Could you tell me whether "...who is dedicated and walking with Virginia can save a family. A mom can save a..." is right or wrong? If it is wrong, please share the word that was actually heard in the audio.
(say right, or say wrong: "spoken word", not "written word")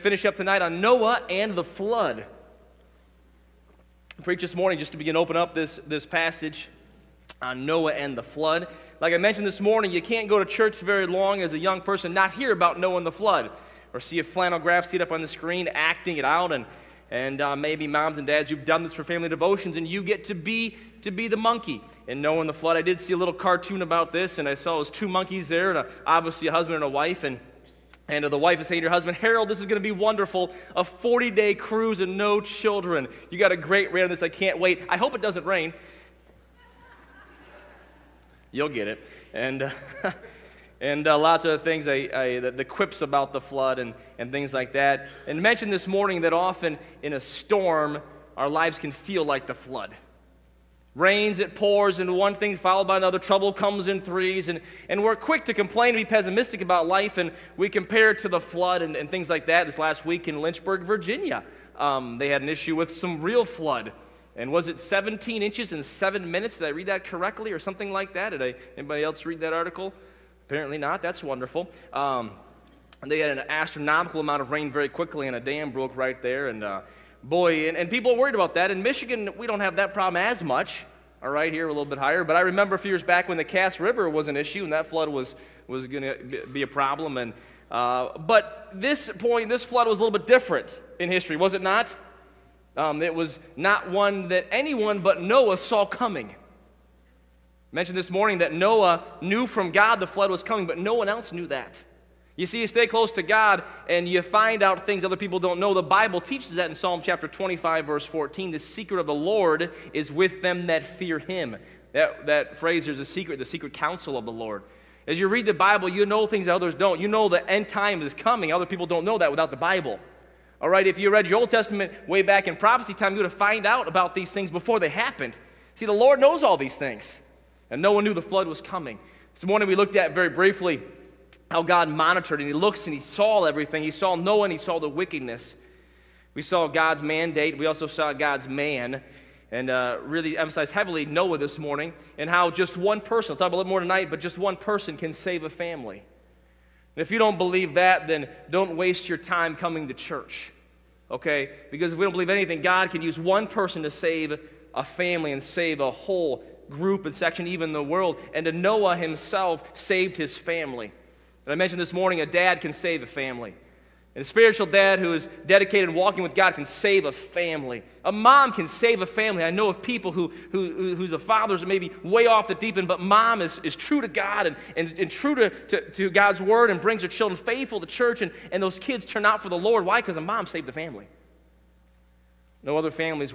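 wrong: "God", not "Virginia".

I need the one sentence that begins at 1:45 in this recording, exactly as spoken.
The Bible teaches that in Psalm chapter 25, verse 14.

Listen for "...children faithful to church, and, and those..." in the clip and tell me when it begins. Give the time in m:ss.
2:57.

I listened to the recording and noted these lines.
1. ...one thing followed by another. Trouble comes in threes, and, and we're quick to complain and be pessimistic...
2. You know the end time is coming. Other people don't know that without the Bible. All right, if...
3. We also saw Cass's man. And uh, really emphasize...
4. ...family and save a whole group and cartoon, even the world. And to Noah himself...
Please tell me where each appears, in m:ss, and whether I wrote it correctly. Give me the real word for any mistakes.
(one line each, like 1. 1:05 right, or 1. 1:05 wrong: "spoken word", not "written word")
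1. 0:52 right
2. 1:57 right
3. 2:17 wrong: "God", not "Cass"
4. 2:34 wrong: "section", not "cartoon".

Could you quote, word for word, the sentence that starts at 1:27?
And uh, but this point, this flood was a little bit different in history, was it not?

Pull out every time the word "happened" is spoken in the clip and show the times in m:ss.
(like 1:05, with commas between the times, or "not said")
2:04.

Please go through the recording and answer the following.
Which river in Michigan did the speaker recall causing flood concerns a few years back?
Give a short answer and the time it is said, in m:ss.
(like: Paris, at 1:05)
Cass River, at 1:23.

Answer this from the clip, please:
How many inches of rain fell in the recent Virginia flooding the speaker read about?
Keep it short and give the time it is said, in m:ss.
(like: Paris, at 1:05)
17, at 1:04.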